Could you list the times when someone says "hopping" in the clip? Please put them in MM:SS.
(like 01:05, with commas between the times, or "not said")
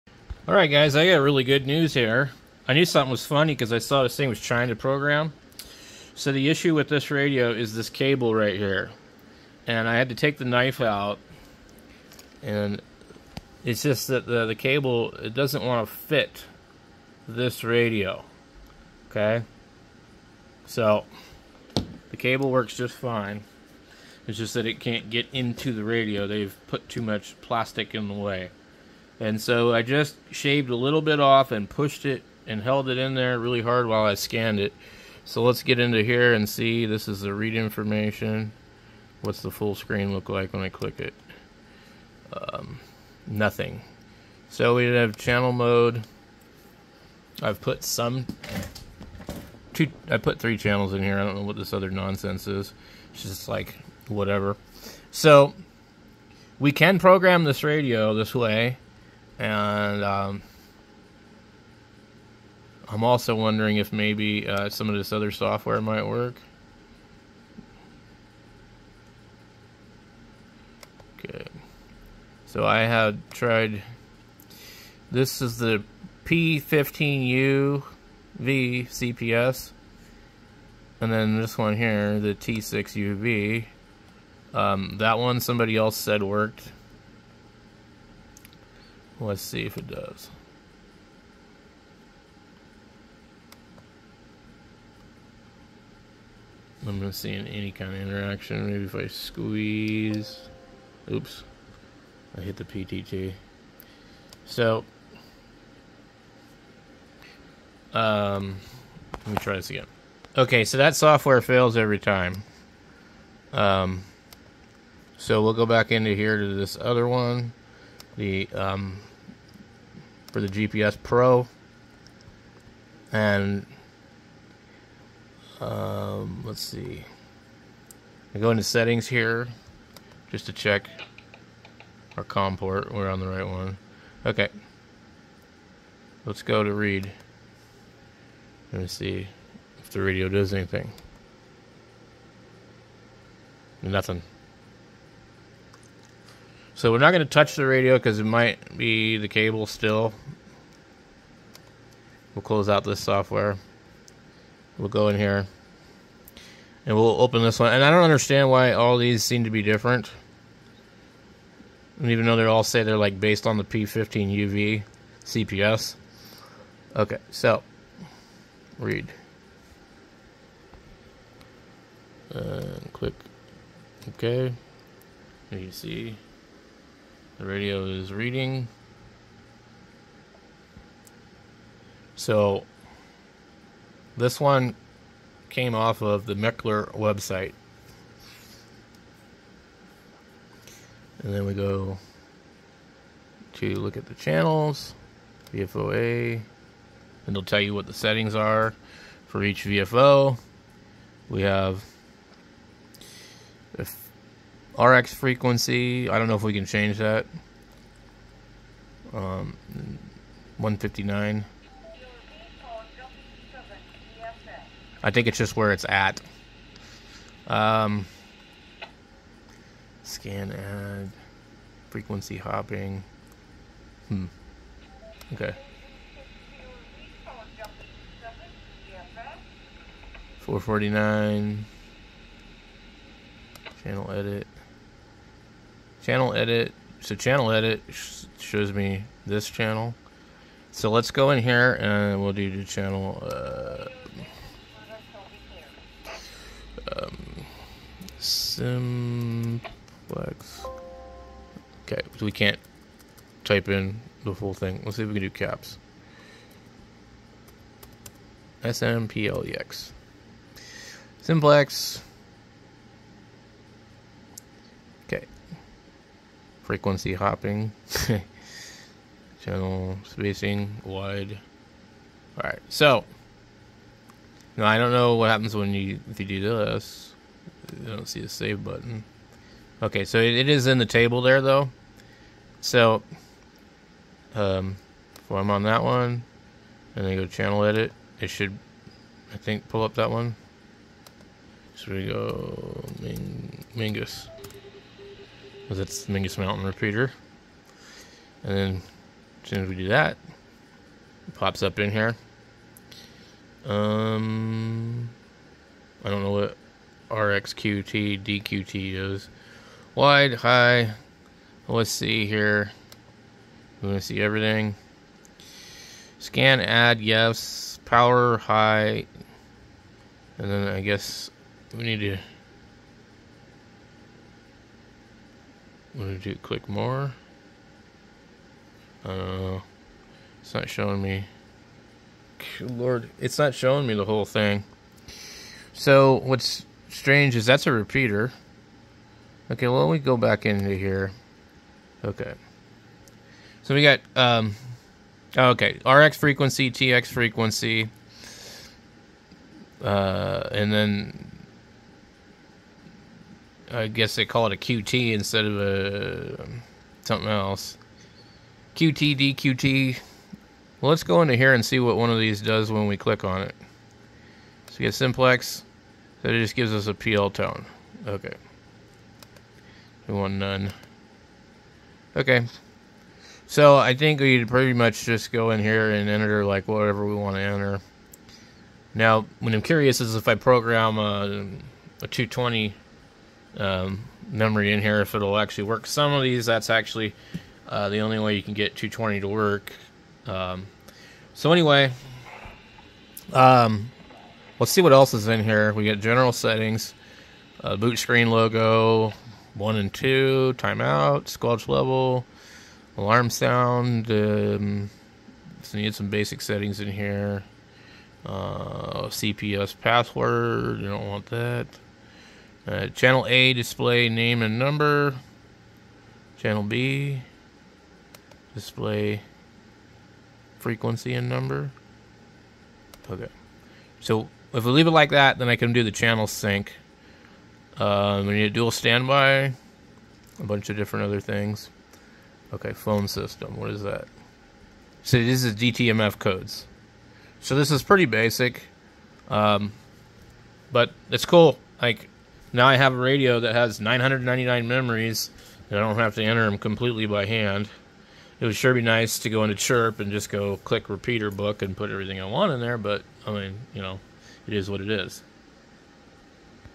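03:42, 04:27.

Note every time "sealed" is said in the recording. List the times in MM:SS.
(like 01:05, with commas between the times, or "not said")
not said.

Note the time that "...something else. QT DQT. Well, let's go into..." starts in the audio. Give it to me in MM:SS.
05:57.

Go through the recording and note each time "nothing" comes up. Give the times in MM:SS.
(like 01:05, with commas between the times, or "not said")
00:43, 02:23.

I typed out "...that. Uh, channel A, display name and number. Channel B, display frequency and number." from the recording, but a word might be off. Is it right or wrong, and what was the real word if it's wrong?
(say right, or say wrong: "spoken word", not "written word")
right.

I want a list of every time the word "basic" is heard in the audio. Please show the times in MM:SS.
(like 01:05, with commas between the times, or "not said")
06:46, 07:18.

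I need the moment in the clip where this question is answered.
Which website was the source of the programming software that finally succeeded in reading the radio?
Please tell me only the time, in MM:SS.
03:06.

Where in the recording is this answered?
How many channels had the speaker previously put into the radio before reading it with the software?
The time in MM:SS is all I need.
00:50.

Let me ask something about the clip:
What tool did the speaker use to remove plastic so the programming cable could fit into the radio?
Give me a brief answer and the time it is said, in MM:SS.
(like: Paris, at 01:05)
knife, at 00:10.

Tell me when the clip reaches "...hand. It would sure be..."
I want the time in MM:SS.
07:27.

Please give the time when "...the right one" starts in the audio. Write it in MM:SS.
02:13.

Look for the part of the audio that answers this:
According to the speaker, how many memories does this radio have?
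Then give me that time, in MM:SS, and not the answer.
07:23.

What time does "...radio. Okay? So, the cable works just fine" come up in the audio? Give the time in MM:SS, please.
00:17.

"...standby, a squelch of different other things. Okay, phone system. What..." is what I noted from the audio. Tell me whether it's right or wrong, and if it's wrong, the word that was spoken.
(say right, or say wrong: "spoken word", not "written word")
wrong: "bunch", not "squelch".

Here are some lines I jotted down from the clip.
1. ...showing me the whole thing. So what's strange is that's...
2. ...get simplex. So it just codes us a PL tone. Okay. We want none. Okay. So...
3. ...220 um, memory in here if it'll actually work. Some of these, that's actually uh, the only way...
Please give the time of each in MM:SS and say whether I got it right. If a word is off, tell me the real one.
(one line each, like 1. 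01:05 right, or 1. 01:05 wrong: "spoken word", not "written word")
1. 05:33 right
2. 06:04 wrong: "gives", not "codes"
3. 06:22 right.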